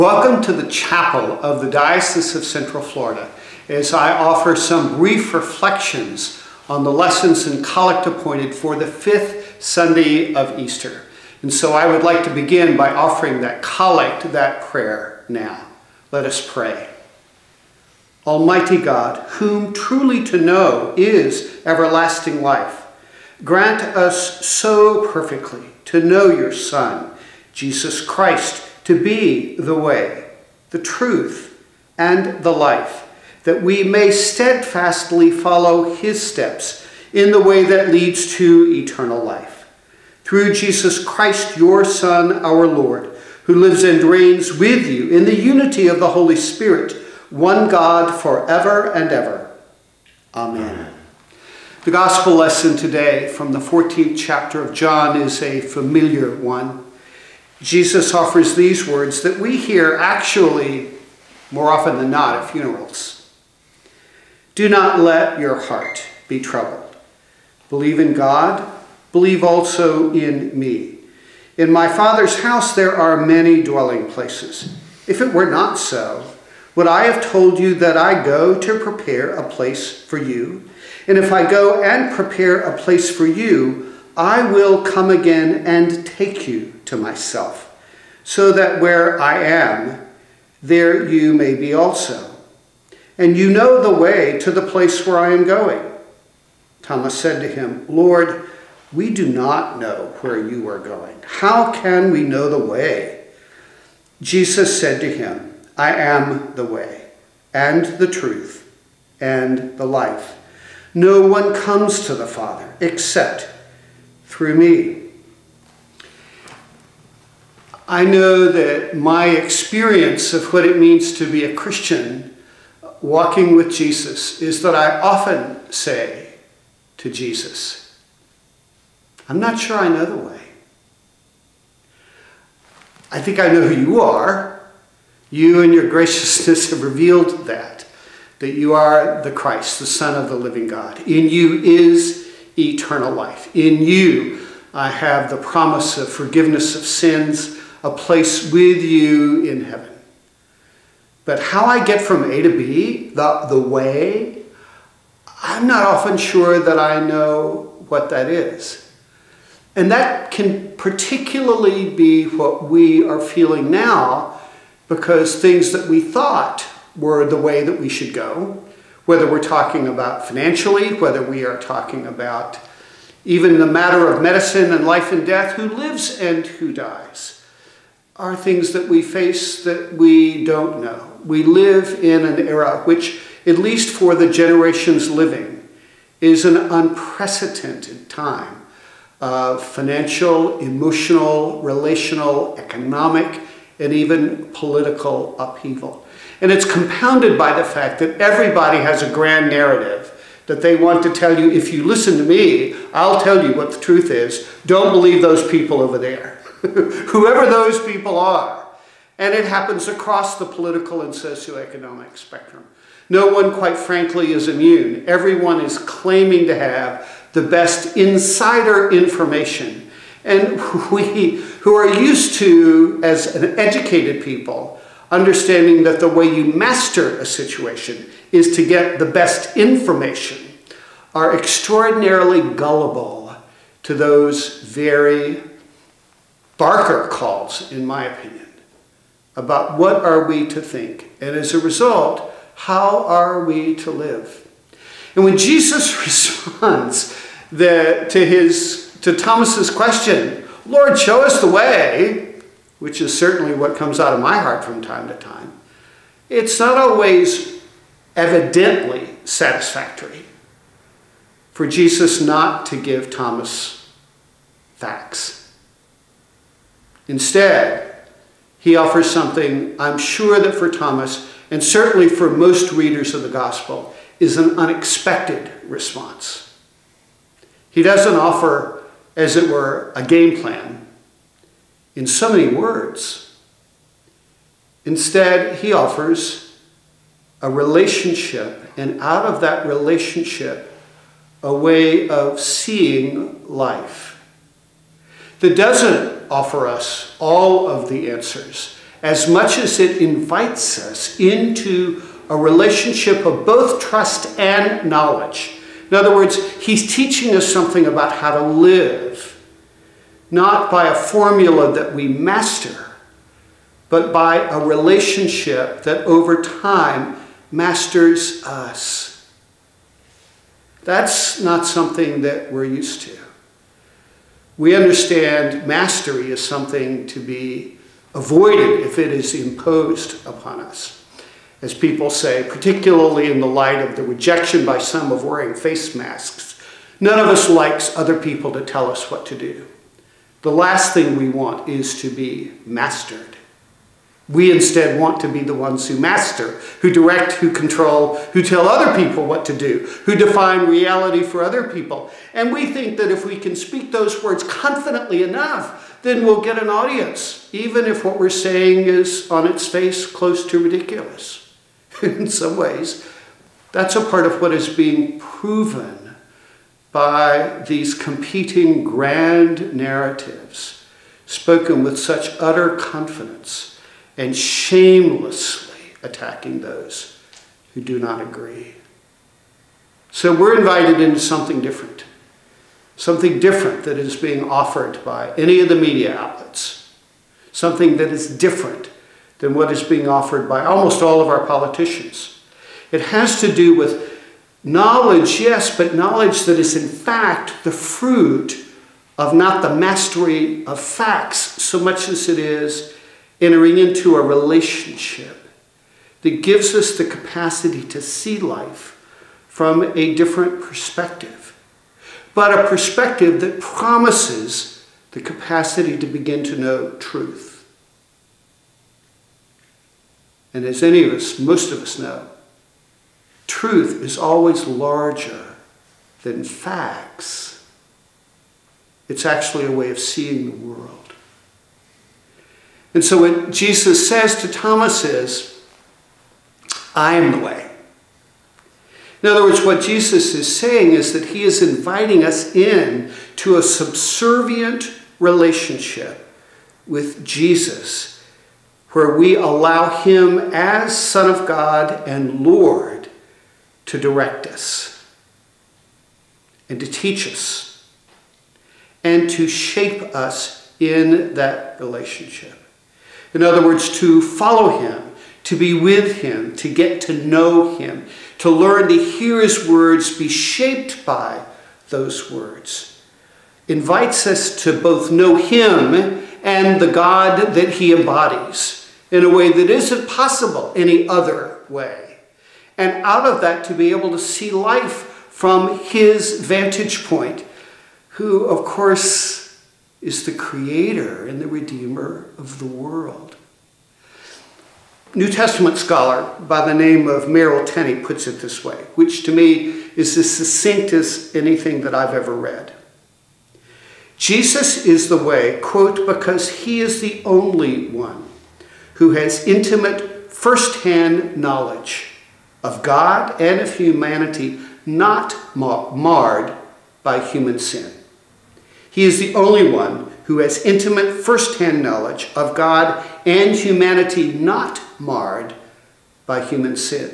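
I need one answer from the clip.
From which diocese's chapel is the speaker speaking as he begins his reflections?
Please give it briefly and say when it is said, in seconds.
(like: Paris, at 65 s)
Central Florida, at 2 s.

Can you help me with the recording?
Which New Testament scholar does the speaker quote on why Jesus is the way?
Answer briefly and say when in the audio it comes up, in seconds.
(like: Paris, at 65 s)
Merrill Tenney, at 497 s.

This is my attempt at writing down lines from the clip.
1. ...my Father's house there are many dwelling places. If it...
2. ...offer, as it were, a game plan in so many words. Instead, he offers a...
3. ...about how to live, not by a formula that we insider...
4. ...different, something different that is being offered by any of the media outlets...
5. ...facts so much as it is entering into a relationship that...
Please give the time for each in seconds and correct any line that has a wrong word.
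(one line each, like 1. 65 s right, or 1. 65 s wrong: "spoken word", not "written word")
1. 71 s right
2. 278 s right
3. 307 s wrong: "master", not "insider"
4. 381 s right
5. 400 s right.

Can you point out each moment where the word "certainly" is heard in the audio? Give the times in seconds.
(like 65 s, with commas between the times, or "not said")
253 s, 271 s.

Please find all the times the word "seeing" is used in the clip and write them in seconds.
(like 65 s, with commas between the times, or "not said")
292 s, 429 s.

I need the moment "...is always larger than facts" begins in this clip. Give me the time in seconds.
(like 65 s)
424 s.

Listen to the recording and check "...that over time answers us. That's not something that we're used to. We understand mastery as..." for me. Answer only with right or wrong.
wrong.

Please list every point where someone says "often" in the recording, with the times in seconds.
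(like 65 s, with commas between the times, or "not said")
61 s, 125 s, 155 s.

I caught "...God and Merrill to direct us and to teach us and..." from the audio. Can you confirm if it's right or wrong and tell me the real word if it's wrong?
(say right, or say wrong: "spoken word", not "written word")
wrong: "Lord", not "Merrill".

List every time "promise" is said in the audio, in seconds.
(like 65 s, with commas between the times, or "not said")
145 s, 413 s.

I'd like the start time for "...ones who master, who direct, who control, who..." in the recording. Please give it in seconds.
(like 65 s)
345 s.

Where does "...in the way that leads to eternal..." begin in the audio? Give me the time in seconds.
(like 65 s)
37 s.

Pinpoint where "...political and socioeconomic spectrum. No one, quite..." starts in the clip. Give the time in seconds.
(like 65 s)
210 s.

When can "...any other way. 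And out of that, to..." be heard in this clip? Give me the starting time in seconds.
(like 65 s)
480 s.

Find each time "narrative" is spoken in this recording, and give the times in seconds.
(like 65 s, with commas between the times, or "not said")
199 s, 369 s.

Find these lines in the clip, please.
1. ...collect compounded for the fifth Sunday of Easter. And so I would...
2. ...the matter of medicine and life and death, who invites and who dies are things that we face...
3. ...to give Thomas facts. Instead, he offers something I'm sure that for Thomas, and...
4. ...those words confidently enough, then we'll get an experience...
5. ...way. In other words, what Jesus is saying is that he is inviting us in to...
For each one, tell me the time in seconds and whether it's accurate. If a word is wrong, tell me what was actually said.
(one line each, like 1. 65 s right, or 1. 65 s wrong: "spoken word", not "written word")
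1. 7 s wrong: "appointed", not "compounded"
2. 173 s wrong: "lives", not "invites"
3. 262 s right
4. 353 s wrong: "audience", not "experience"
5. 437 s right.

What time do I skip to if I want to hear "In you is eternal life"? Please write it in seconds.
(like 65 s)
141 s.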